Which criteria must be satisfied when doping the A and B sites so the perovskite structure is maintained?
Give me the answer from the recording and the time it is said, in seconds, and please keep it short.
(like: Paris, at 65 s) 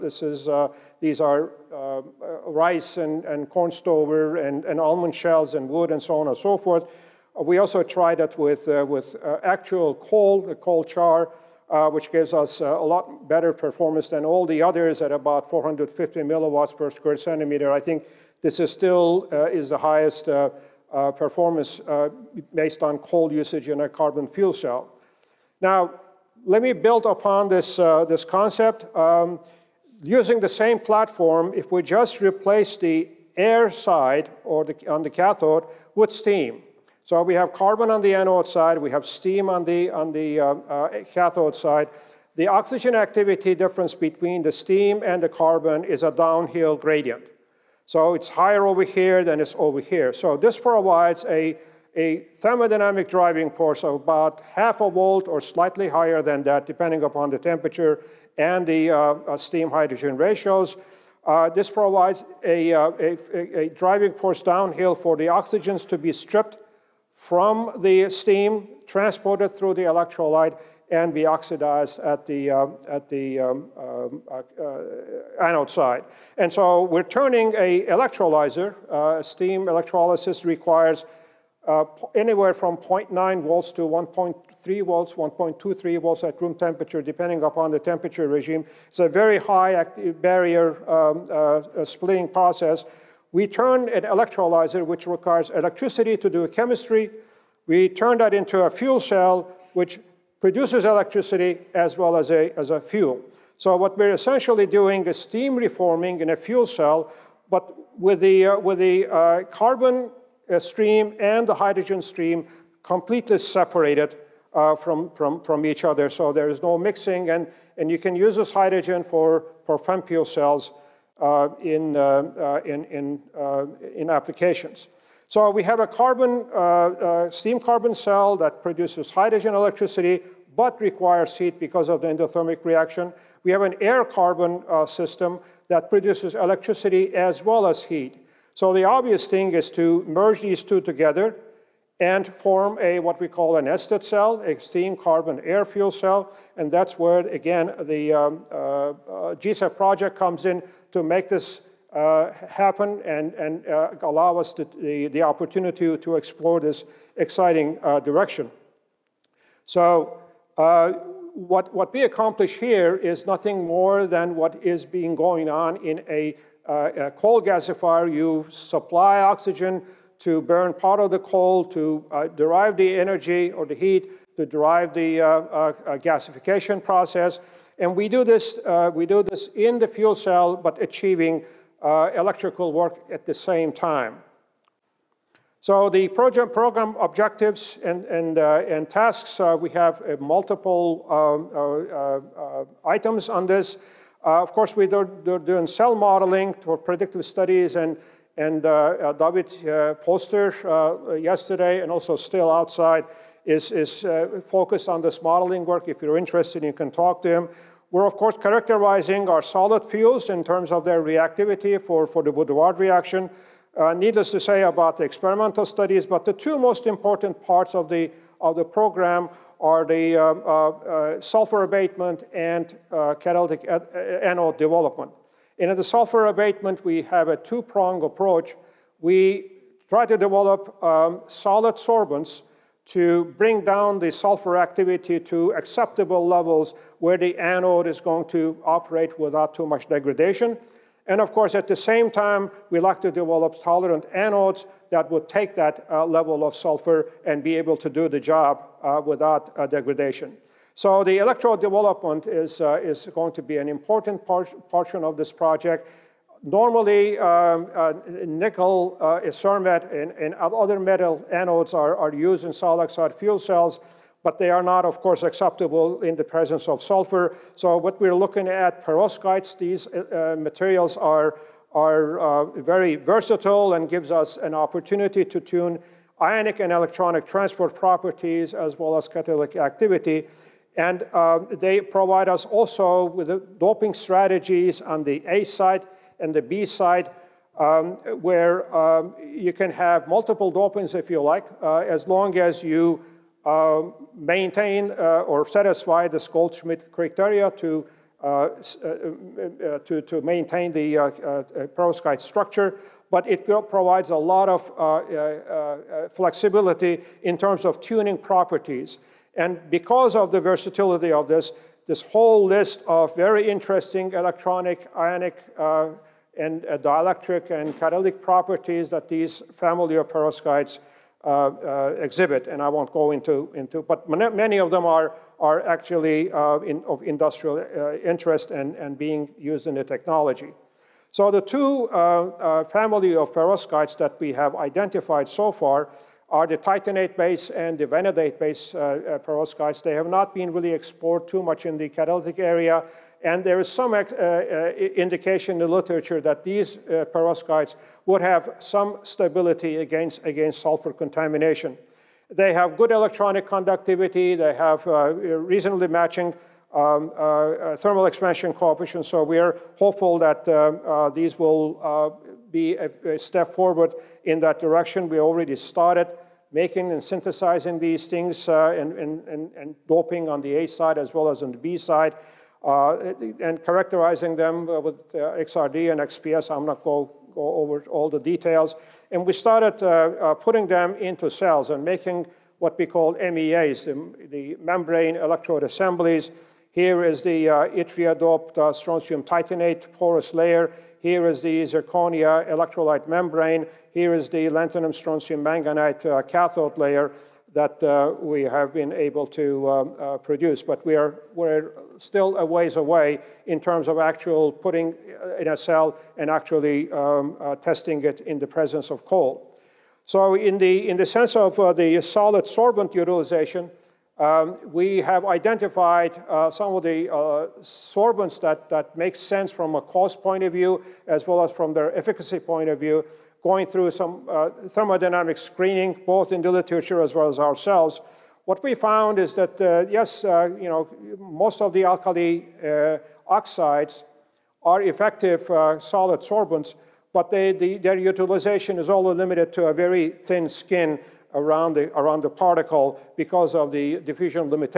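Goldschmidt criteria, at 296 s.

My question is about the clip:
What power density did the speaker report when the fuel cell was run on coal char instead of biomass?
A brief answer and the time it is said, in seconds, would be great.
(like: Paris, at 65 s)
450 mW/cm², at 15 s.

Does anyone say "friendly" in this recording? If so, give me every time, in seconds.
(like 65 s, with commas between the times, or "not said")
not said.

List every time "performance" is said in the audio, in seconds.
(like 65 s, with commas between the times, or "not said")
13 s, 21 s.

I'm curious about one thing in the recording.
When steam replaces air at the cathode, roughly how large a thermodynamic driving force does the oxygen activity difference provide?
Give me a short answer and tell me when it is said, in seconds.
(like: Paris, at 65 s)
half a volt, at 54 s.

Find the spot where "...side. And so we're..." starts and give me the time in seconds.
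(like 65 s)
75 s.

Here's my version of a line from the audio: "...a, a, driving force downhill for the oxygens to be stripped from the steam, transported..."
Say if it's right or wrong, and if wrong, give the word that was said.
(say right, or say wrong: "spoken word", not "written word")
right.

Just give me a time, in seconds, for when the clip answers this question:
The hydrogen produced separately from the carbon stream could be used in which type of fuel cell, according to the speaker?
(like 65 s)
119 s.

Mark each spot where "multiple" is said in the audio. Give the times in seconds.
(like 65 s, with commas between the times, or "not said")
190 s, 290 s.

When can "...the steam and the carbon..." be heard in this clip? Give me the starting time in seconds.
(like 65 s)
44 s.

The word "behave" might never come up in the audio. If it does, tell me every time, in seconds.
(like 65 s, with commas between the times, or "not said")
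not said.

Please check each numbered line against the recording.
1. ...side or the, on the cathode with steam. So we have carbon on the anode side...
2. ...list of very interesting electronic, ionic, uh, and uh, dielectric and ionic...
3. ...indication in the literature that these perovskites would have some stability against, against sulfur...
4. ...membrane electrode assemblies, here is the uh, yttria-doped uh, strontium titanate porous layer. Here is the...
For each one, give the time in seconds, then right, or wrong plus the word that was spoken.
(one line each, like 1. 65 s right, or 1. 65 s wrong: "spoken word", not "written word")
1. 33 s right
2. 312 s wrong: "catalytic", not "ionic"
3. 344 s right
4. 384 s right.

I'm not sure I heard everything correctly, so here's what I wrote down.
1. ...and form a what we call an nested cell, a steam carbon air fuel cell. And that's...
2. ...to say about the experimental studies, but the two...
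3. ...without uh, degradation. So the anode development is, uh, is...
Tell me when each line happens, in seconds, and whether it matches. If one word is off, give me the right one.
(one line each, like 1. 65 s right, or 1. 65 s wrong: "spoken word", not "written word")
1. 142 s right
2. 214 s right
3. 249 s wrong: "electrode", not "anode".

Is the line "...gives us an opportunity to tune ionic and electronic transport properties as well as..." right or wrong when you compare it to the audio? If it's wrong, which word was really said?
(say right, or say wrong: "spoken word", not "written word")
right.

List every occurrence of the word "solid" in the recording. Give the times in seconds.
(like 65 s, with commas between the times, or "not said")
209 s, 231 s, 262 s, 412 s, 435 s.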